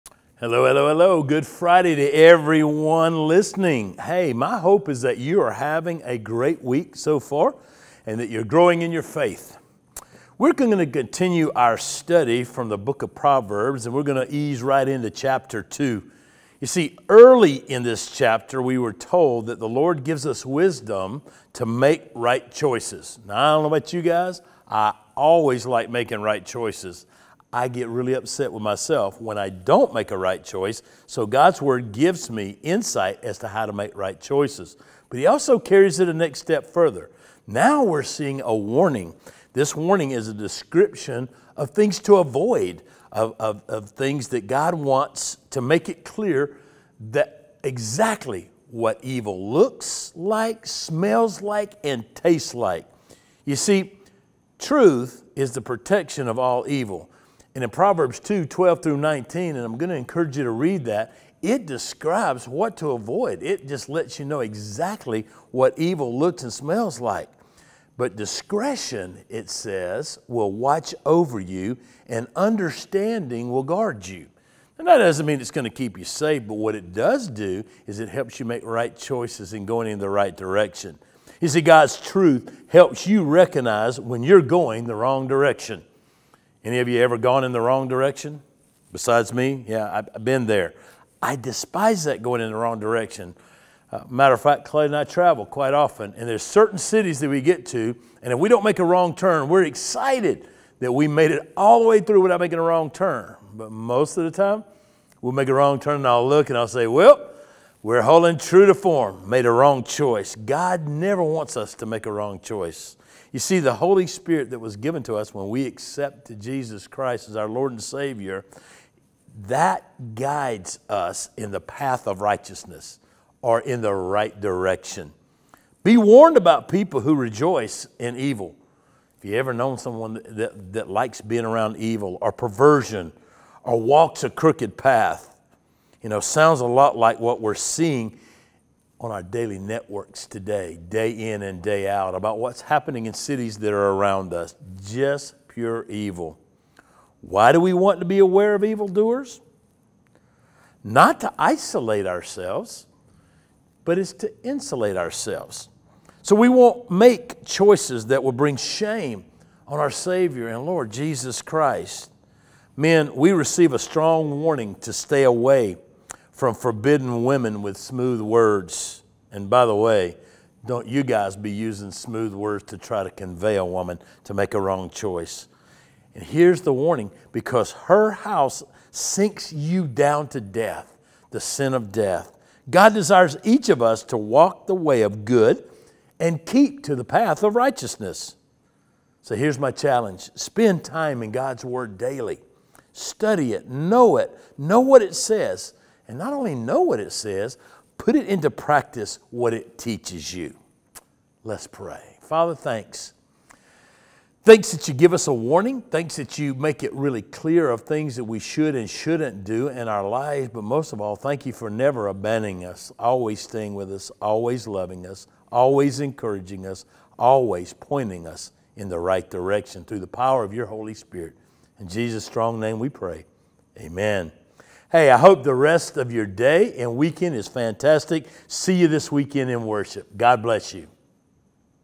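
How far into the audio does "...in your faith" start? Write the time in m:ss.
0:08.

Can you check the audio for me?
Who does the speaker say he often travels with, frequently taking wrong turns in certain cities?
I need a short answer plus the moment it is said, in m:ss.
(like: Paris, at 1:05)
Clay, at 1:34.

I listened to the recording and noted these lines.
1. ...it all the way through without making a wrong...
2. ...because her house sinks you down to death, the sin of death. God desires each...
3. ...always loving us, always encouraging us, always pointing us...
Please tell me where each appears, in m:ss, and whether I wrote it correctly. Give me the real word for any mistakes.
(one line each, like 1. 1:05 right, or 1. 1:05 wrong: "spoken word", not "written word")
1. 1:41 right
2. 2:57 right
3. 3:34 right.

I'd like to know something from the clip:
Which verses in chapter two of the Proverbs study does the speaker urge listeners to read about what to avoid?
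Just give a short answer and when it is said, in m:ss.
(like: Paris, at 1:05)
12 through 19, at 0:58.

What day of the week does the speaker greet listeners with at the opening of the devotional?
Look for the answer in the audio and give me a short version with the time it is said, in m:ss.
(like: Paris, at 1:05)
Friday, at 0:01.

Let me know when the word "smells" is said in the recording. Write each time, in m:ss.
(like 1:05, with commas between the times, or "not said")
0:50, 1:06.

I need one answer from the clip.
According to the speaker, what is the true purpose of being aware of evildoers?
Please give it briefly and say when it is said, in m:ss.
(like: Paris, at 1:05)
insulate ourselves, at 2:34.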